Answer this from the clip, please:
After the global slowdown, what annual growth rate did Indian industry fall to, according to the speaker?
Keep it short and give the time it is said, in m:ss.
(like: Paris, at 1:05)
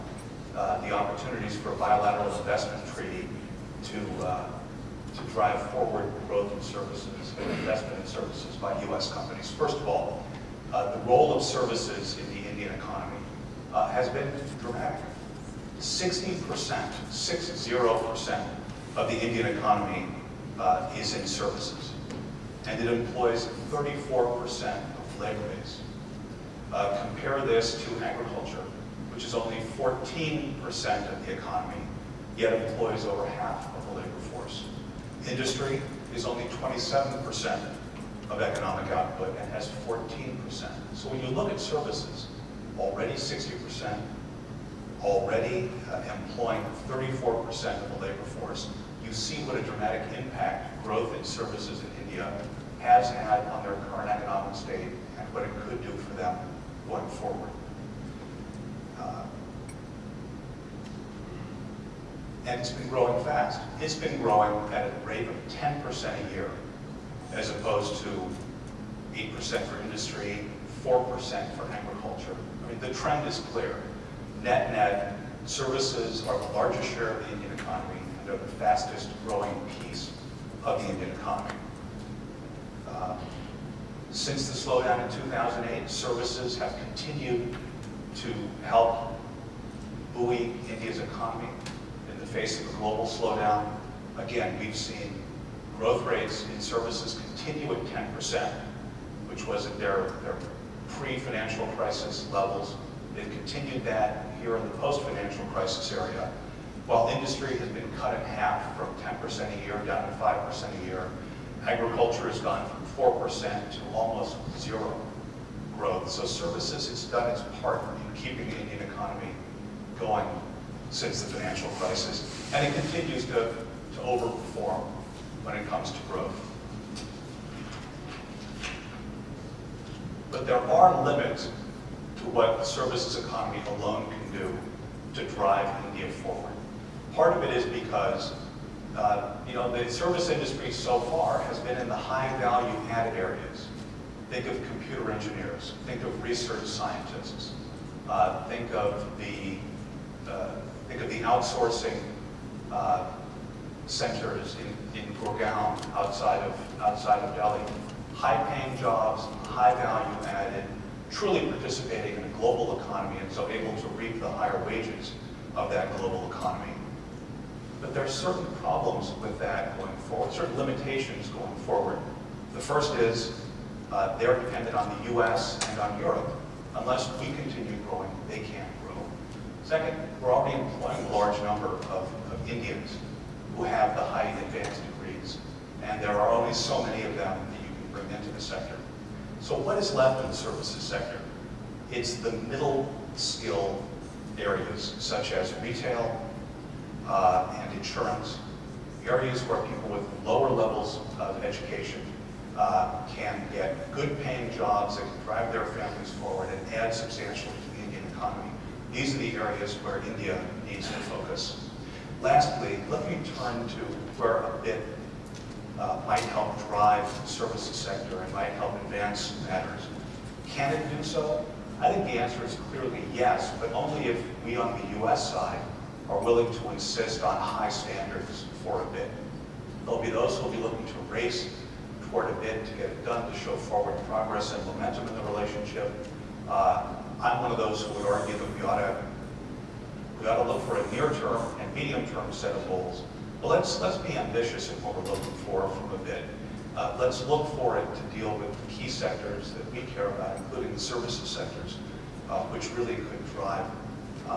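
5%, at 1:50.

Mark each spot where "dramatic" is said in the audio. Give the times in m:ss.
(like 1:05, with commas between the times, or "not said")
0:14, 0:49.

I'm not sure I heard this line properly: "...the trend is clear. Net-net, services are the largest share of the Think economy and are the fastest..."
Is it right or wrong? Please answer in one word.
wrong.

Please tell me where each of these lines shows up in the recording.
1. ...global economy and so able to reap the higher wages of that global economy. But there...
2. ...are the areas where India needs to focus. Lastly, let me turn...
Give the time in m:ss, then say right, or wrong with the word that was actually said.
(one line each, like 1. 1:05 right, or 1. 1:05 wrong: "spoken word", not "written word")
1. 2:42 right
2. 3:29 right.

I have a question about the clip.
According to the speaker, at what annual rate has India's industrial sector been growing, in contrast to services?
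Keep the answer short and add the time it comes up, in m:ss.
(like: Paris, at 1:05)
8%, at 1:09.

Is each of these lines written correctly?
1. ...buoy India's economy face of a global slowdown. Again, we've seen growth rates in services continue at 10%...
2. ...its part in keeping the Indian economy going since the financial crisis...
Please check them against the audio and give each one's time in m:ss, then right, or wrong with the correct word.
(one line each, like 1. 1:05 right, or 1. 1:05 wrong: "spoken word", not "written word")
1. 1:30 right
2. 1:57 right.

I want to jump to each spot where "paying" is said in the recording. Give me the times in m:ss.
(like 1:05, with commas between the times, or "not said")
2:38, 3:24.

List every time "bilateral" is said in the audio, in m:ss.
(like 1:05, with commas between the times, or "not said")
0:01.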